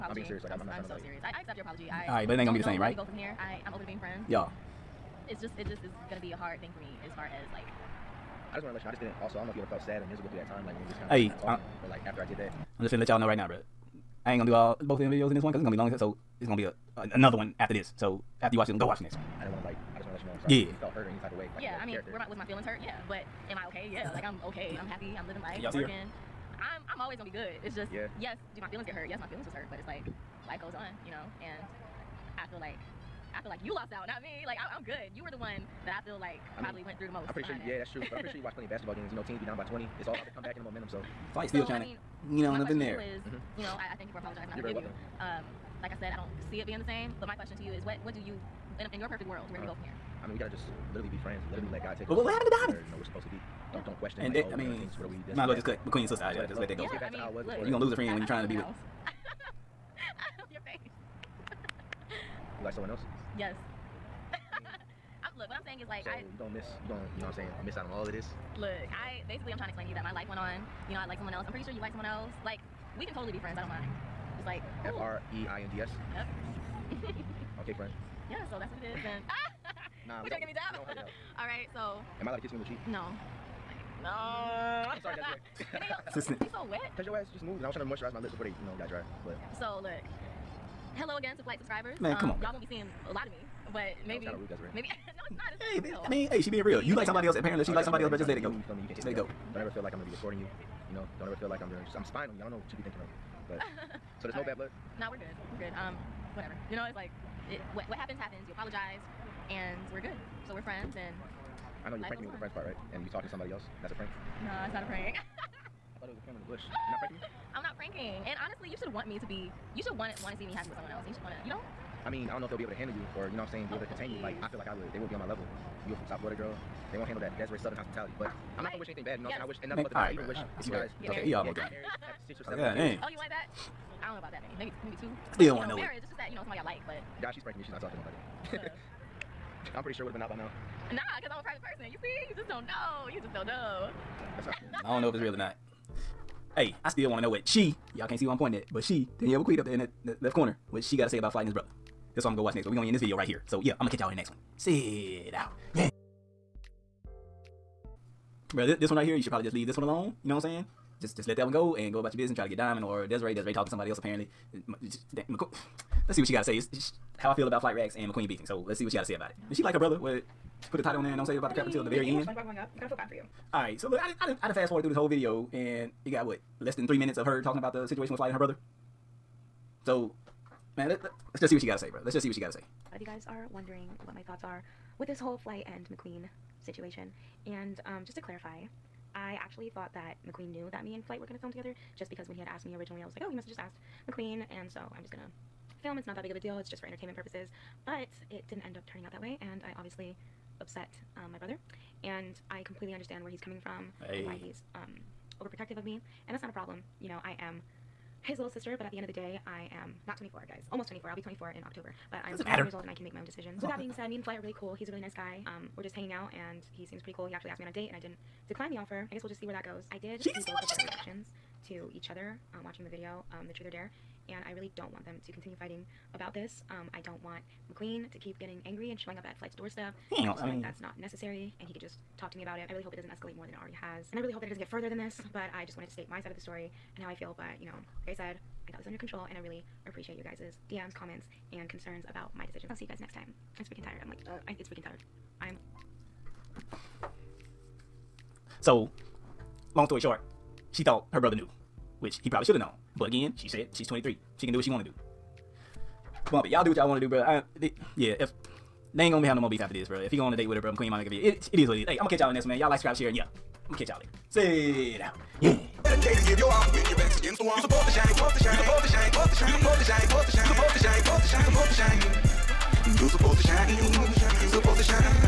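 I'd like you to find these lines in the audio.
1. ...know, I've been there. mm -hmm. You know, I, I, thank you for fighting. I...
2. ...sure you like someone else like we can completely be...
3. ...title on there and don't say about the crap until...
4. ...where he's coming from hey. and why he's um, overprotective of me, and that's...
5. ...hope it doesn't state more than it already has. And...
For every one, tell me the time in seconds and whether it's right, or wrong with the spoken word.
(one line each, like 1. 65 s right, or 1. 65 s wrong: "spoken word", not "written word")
1. 42 s wrong: "apologizing", not "fighting"
2. 71 s wrong: "totally", not "completely"
3. 170 s right
4. 203 s right
5. 232 s wrong: "escalate", not "state".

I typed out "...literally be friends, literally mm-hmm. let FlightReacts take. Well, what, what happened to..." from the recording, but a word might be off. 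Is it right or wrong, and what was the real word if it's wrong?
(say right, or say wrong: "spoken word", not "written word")
wrong: "God", not "FlightReacts".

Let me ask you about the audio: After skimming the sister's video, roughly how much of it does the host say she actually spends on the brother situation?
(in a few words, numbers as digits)
Less than three minutes.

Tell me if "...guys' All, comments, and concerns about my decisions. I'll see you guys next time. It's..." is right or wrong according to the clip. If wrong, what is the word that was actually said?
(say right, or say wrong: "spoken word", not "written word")
wrong: "DMs", not "All".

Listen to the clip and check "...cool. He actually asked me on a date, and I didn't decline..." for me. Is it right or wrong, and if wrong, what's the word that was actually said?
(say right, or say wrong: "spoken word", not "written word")
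right.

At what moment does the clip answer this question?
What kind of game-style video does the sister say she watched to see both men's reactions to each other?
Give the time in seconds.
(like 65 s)
223 s.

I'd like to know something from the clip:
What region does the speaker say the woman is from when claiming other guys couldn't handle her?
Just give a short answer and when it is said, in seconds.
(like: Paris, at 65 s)
South Florida, at 126 s.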